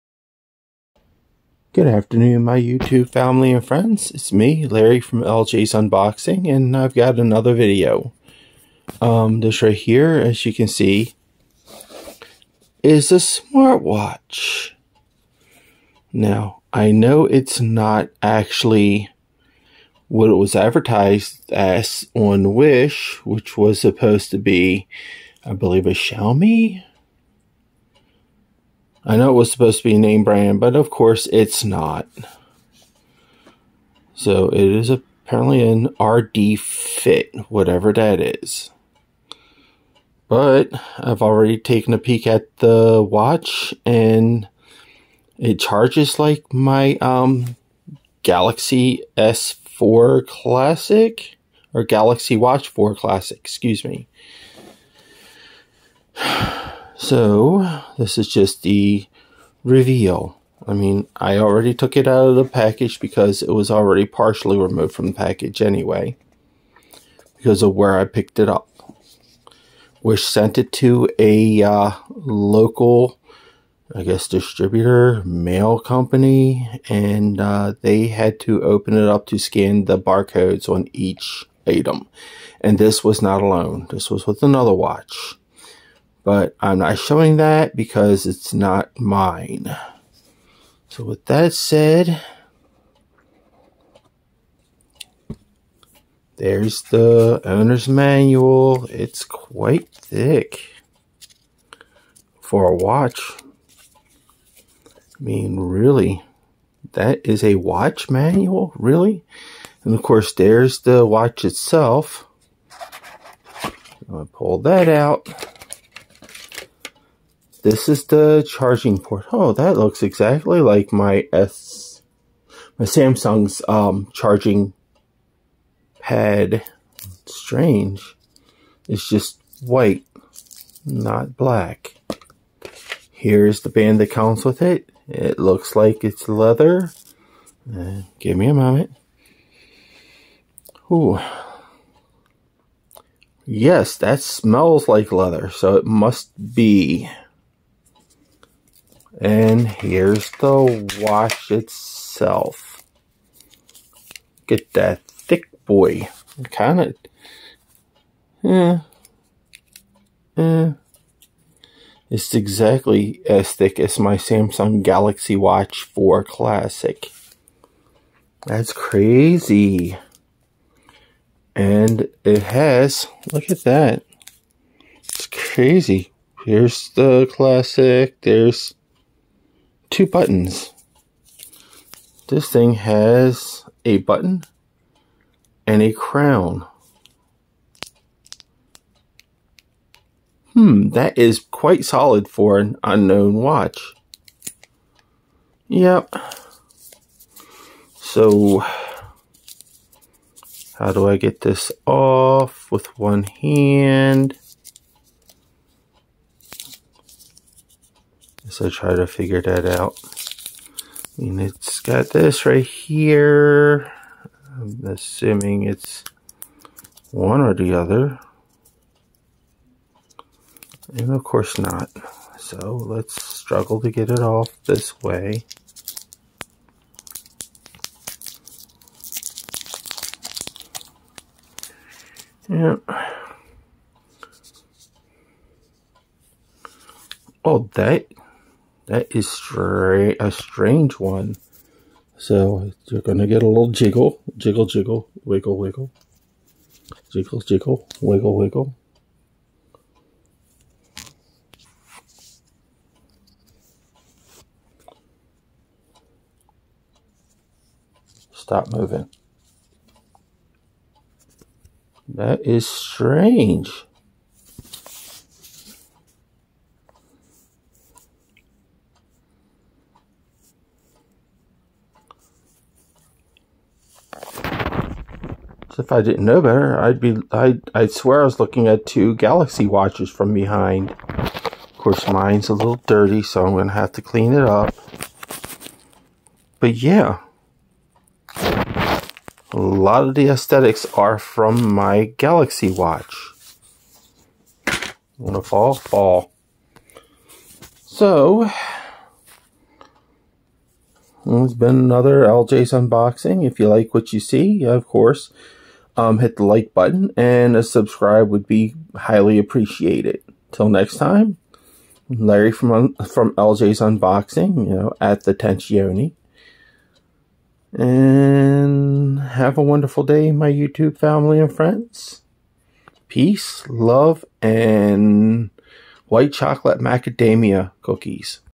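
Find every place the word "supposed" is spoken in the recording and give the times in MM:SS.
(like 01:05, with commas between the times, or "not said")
00:23, 00:29.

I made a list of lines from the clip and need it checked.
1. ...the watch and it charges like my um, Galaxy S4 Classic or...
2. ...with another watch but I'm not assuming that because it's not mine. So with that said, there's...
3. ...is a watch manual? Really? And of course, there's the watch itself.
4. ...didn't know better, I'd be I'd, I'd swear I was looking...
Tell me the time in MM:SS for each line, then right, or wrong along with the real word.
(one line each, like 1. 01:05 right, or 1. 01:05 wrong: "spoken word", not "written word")
1. 00:42 right
2. 01:24 wrong: "showing", not "assuming"
3. 01:47 right
4. 04:36 right.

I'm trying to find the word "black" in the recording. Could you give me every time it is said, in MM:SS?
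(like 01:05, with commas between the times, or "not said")
02:11.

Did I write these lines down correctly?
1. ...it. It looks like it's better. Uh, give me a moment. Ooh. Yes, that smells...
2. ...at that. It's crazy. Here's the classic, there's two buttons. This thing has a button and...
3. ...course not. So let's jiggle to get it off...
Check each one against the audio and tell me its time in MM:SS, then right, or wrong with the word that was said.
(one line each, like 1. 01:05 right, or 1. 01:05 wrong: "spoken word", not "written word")
1. 02:14 wrong: "leather", not "better"
2. 02:53 right
3. 03:41 wrong: "struggle", not "jiggle".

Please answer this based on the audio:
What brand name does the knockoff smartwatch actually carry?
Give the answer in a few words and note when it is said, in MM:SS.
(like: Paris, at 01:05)
RDFIT, at 00:35.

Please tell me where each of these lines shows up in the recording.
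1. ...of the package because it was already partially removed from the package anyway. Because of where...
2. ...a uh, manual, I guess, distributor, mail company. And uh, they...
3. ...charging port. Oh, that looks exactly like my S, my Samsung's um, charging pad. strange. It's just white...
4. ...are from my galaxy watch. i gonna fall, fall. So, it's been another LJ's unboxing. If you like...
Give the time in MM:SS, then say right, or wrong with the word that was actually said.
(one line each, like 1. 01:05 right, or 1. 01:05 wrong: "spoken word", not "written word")
1. 01:02 right
2. 01:11 wrong: "local", not "manual"
3. 01:58 right
4. 04:50 right.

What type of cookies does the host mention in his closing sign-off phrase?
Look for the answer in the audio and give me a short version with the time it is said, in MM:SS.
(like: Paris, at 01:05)
White chocolate macadamia, at 05:26.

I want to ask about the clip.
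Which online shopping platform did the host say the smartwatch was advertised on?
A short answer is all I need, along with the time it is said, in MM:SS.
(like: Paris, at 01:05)
Wish, at 00:22.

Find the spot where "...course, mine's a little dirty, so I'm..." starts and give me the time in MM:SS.
04:41.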